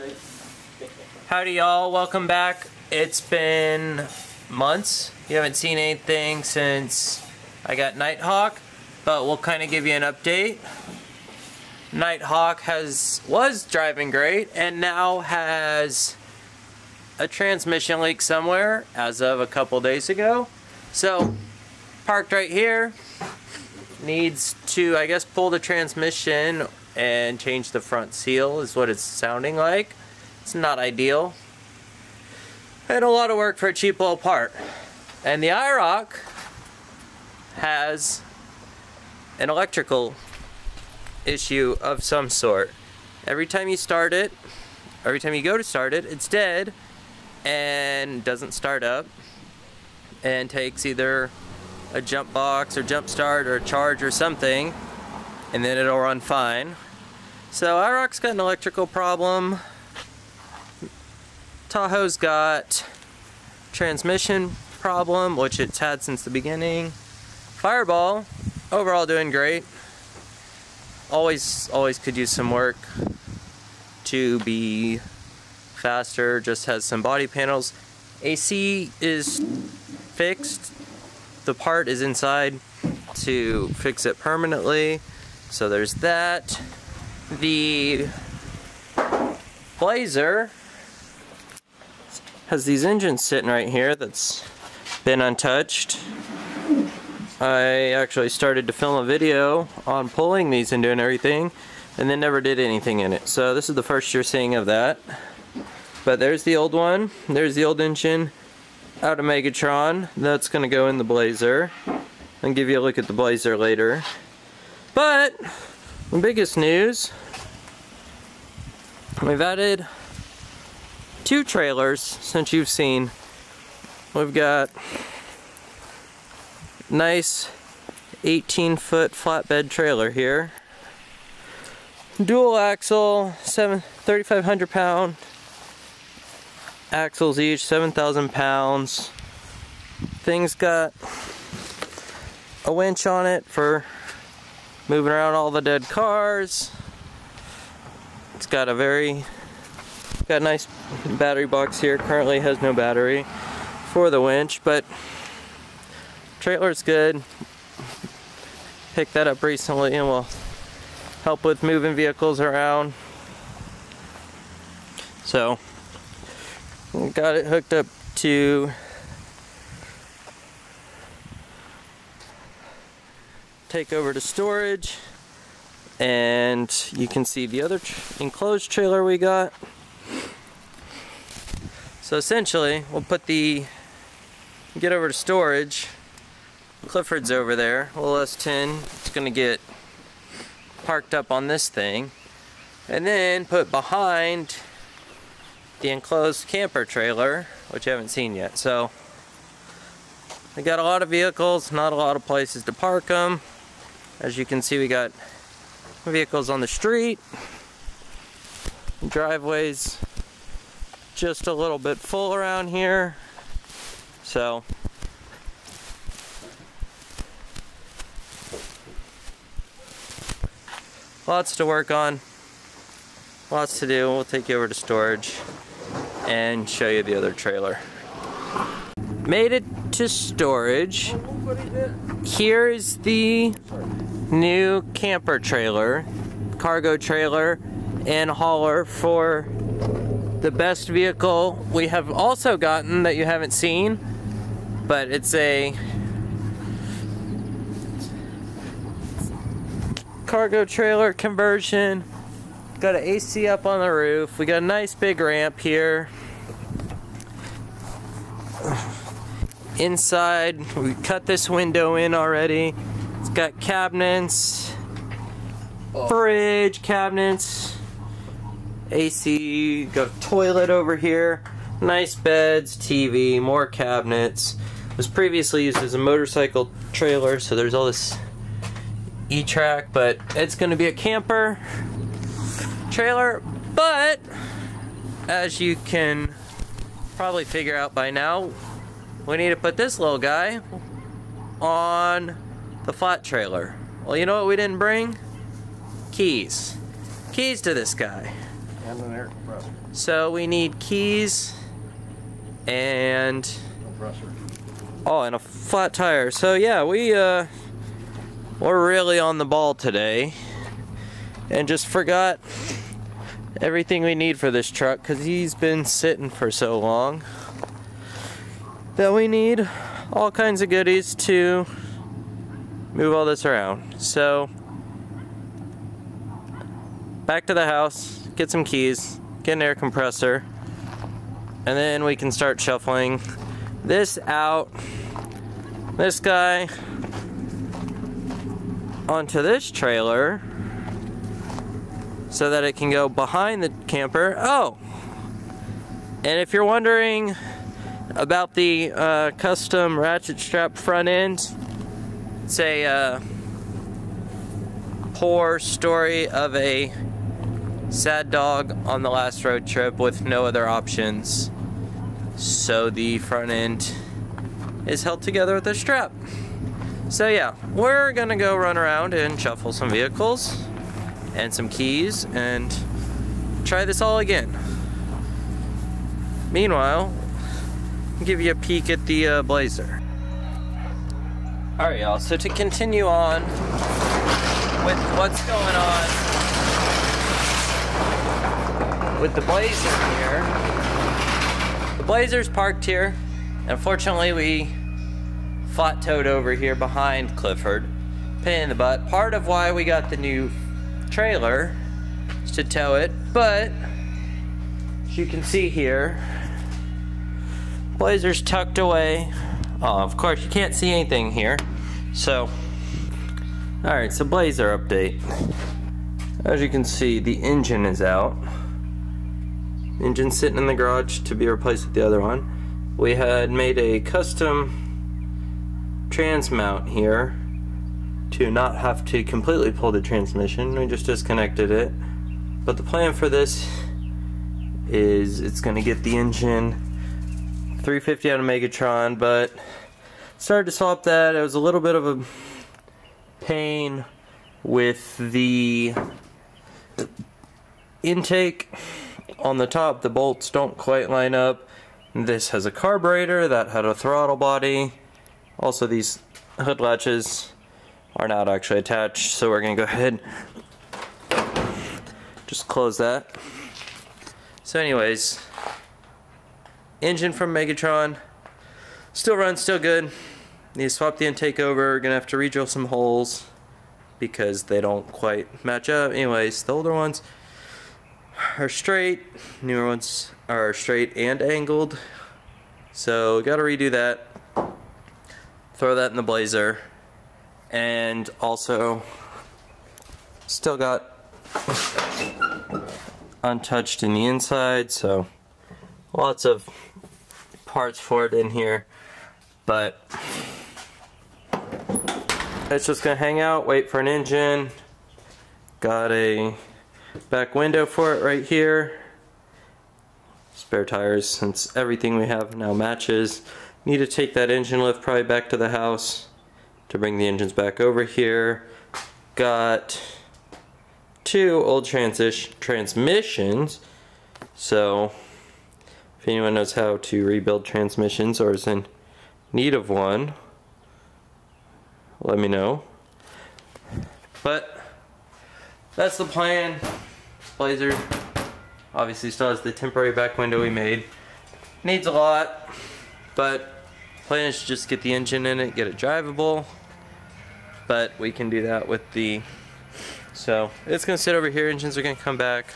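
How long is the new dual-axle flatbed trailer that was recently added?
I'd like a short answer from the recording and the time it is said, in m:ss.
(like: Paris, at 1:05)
18 foot, at 2:08.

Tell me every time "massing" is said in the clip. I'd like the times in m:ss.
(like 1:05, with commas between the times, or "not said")
not said.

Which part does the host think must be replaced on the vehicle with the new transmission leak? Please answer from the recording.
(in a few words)
front seal.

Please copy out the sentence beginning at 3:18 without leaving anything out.
So we got a lot of vehicles, not a lot of places to park them.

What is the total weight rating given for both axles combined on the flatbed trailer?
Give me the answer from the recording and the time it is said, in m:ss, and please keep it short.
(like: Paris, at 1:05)
7,000 pounds, at 2:17.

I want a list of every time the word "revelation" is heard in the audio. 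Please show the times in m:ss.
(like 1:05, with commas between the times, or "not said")
not said.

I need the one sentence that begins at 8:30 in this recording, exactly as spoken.
Spare tires since everything we have now matches.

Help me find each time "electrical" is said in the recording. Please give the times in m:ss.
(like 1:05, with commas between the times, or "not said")
0:39, 0:58.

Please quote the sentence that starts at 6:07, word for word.
So yeah, we're gonna go run around and shuffle some vehicles and some keys and try this all again.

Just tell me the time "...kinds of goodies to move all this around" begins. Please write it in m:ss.
5:20.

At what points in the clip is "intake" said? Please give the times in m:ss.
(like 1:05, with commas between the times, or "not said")
7:28, 7:51.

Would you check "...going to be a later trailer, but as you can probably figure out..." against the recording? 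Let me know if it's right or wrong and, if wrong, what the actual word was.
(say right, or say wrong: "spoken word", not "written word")
wrong: "camper", not "later".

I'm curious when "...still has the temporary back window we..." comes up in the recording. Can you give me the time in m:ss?
8:59.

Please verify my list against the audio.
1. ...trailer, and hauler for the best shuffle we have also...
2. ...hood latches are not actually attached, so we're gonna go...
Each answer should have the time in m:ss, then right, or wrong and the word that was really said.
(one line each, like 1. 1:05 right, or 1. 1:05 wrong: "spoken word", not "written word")
1. 3:56 wrong: "vehicle", not "shuffle"
2. 7:36 right.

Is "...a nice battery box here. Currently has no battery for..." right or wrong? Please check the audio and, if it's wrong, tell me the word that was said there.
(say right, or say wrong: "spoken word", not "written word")
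right.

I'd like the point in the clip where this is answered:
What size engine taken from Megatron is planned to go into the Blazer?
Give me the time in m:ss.
7:17.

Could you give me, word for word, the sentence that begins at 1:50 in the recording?
That's going to go in the Blazer.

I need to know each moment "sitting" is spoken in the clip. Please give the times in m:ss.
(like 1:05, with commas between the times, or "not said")
1:33, 5:15, 7:00.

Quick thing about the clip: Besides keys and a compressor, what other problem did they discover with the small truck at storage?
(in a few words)
a flat tire.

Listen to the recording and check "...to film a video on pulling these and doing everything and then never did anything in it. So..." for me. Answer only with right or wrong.
right.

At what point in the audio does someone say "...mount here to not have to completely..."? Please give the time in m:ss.
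7:06.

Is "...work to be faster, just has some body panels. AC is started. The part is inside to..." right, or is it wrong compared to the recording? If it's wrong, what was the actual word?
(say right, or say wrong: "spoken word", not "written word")
wrong: "fixed", not "started".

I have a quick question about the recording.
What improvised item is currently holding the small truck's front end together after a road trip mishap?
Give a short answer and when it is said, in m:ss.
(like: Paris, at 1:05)
ratchet strap, at 5:49.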